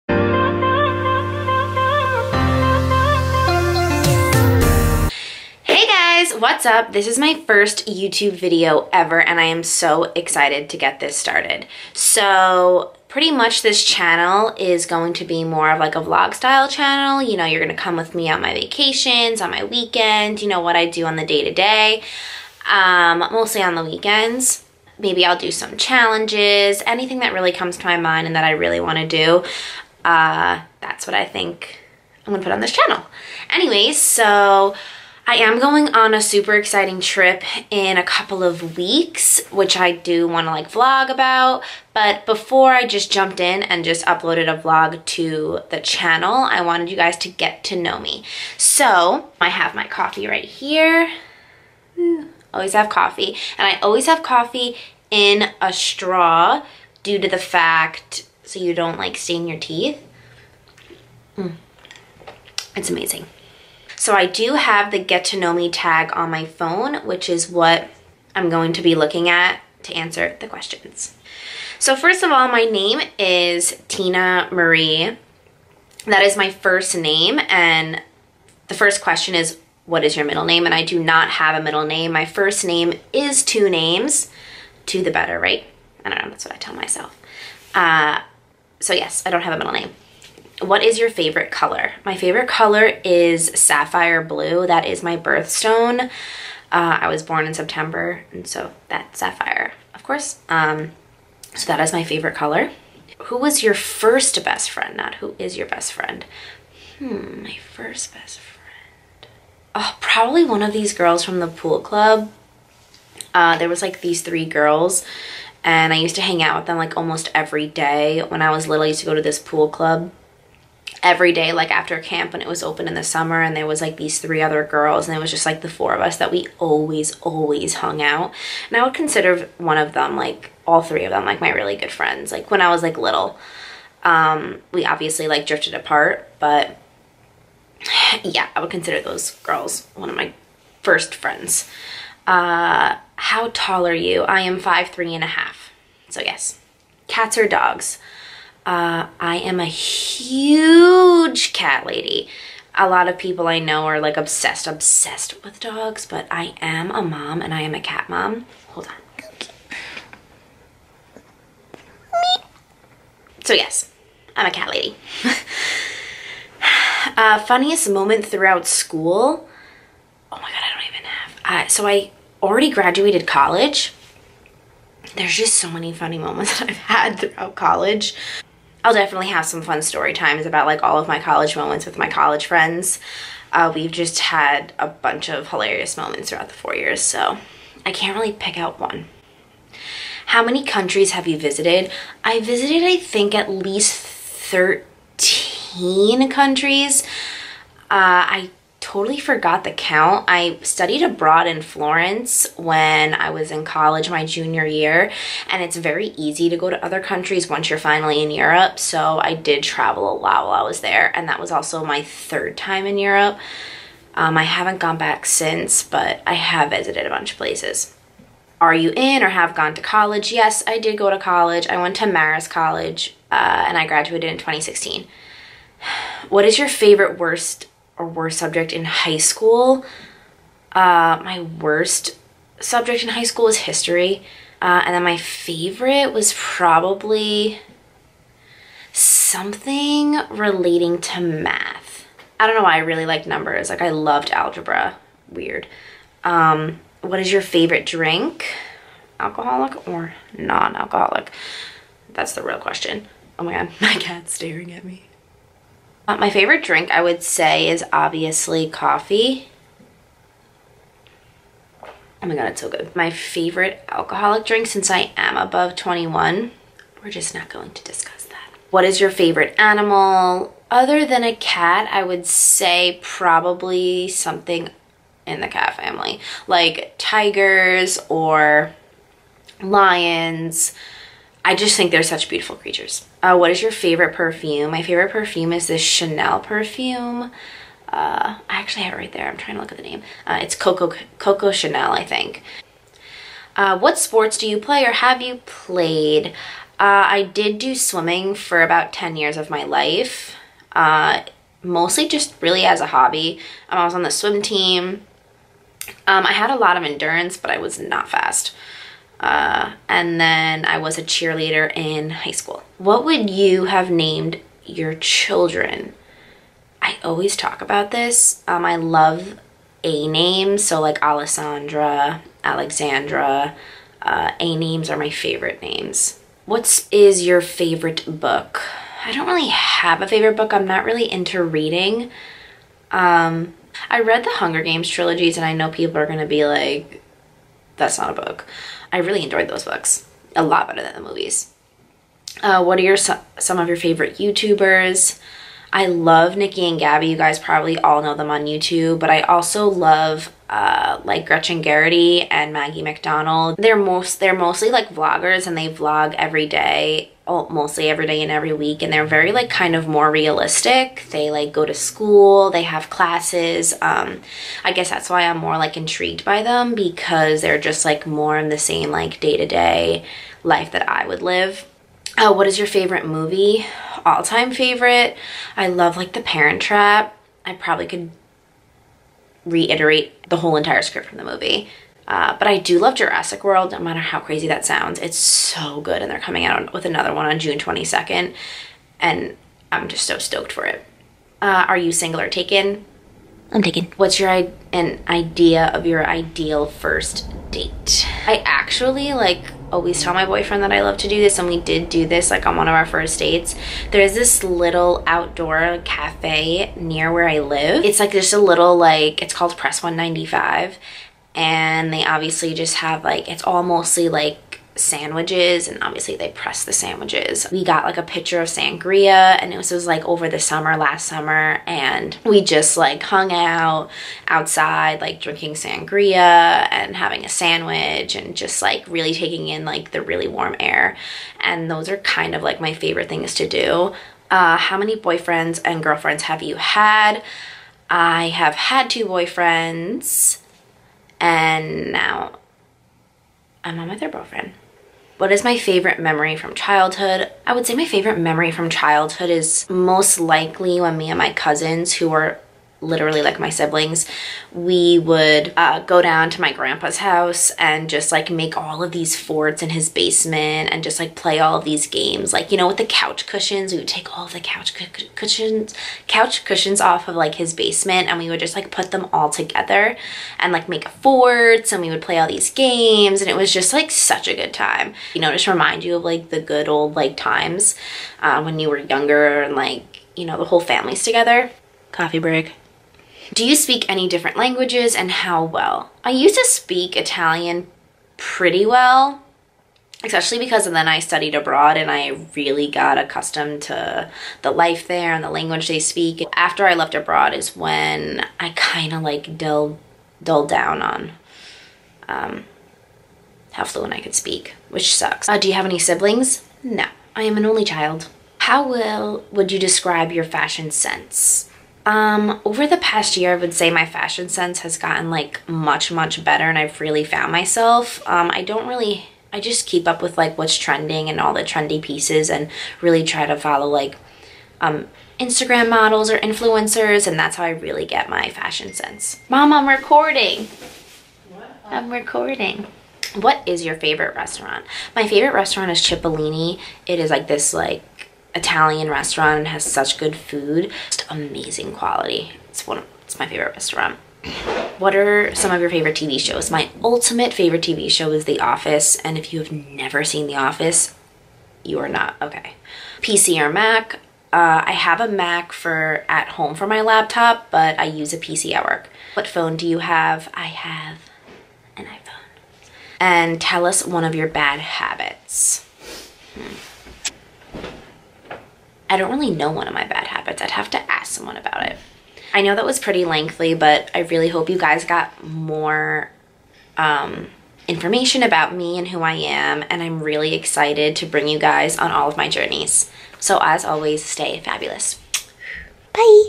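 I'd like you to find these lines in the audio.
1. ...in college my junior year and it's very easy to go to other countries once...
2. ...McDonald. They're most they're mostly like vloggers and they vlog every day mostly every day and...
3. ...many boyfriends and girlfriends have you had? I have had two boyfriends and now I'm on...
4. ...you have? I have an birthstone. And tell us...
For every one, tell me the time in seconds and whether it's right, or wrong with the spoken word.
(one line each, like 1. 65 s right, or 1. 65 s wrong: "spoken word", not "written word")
1. 203 s right
2. 352 s right
3. 434 s right
4. 559 s wrong: "iPhone", not "birthstone".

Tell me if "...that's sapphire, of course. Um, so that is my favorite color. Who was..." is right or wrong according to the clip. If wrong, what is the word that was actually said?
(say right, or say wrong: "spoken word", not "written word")
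right.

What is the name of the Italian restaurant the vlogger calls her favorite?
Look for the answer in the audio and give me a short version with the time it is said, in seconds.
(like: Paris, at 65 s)
Cipollini, at 535 s.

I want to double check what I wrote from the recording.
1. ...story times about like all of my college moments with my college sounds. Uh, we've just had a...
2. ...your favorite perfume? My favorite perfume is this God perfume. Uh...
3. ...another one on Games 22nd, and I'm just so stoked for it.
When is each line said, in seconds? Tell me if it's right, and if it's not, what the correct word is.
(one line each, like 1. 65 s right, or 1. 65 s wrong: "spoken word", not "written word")
1. 179 s wrong: "friends", not "sounds"
2. 283 s wrong: "Chanel", not "God"
3. 386 s wrong: "June", not "Games".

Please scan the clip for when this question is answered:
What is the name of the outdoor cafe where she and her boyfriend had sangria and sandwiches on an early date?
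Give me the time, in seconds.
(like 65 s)
409 s.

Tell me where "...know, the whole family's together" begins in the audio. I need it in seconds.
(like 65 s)
480 s.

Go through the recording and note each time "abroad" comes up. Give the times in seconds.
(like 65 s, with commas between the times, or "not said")
201 s, 491 s, 496 s.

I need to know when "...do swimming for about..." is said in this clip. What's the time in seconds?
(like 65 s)
297 s.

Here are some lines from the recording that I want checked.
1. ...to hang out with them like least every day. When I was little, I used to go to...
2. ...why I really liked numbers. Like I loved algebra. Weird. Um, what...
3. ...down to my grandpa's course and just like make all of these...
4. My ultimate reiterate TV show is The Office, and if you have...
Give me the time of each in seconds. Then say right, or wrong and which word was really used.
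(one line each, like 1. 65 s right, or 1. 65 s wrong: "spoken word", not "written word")
1. 116 s wrong: "almost", not "least"
2. 242 s right
3. 456 s wrong: "house", not "course"
4. 546 s wrong: "favorite", not "reiterate".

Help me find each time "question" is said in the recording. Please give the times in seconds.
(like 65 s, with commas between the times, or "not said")
70 s, 79 s, 252 s.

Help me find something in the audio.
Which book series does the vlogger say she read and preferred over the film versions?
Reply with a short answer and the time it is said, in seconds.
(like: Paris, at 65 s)
The Hunger Games, at 334 s.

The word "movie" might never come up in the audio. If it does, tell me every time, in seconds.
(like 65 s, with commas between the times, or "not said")
341 s, 373 s, 381 s.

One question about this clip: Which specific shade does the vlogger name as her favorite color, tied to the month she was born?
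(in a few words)
Sapphire blue.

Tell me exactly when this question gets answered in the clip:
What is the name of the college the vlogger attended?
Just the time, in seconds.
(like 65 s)
222 s.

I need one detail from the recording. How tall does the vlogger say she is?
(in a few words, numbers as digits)
5'3.5".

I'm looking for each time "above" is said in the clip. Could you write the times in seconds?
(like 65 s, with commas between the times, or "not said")
265 s.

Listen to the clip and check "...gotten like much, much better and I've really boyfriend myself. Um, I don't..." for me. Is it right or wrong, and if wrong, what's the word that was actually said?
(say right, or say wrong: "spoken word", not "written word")
wrong: "found", not "boyfriend".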